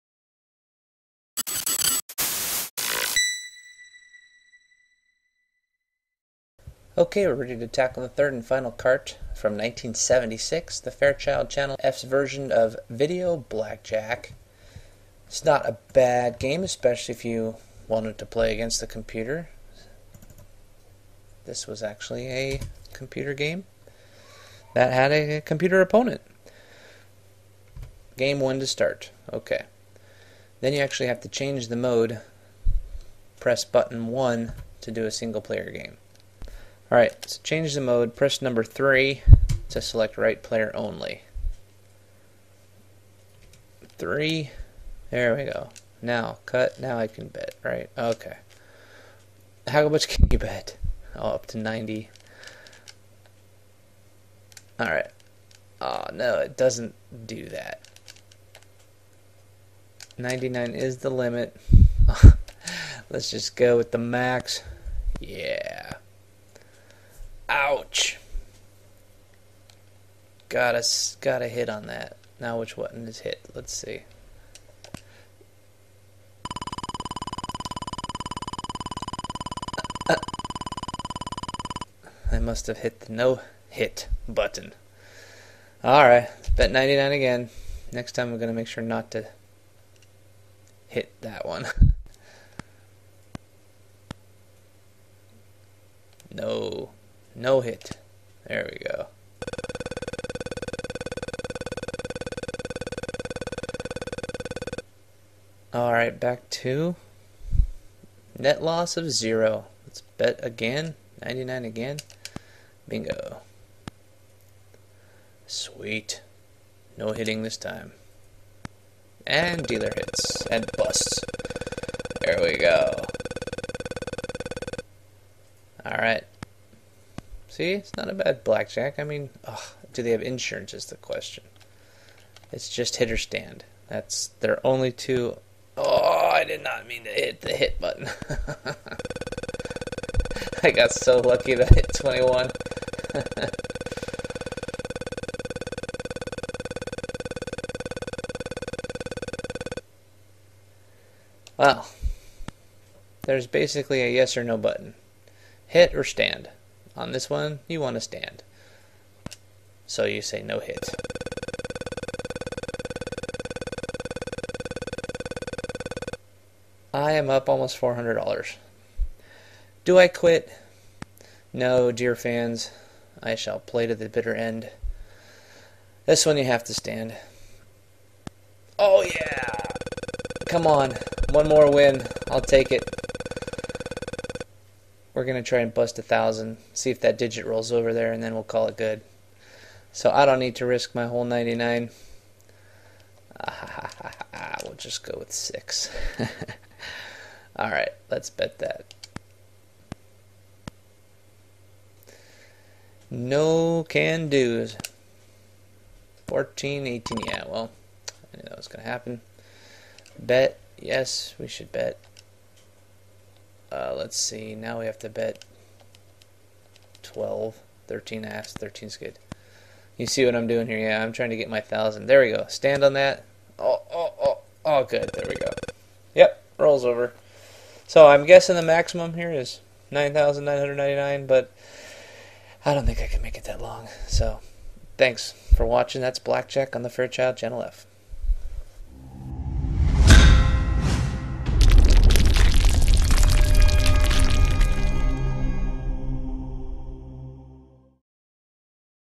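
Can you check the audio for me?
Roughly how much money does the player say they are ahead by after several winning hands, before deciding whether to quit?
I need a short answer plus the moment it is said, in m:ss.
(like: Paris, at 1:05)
almost $400, at 2:47.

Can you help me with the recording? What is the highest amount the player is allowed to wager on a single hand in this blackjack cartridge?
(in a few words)
99.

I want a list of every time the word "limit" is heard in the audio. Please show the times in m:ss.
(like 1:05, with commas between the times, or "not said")
1:01.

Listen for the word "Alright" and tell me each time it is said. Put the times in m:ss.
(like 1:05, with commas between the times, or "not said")
0:36, 0:54, 1:25, 1:45, 2:05.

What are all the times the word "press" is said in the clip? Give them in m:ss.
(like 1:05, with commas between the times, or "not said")
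0:33, 0:38.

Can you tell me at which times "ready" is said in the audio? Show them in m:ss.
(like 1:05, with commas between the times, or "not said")
0:07.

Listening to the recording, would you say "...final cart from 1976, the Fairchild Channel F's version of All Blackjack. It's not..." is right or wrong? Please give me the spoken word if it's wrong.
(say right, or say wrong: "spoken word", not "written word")
wrong: "Video", not "All".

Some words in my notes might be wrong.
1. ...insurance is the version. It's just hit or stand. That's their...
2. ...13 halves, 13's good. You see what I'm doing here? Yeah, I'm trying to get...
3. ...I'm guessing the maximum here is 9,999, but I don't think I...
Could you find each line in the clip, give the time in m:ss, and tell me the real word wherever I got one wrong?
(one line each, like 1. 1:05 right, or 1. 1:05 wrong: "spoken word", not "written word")
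1. 2:10 wrong: "question", not "version"
2. 3:37 right
3. 3:48 right.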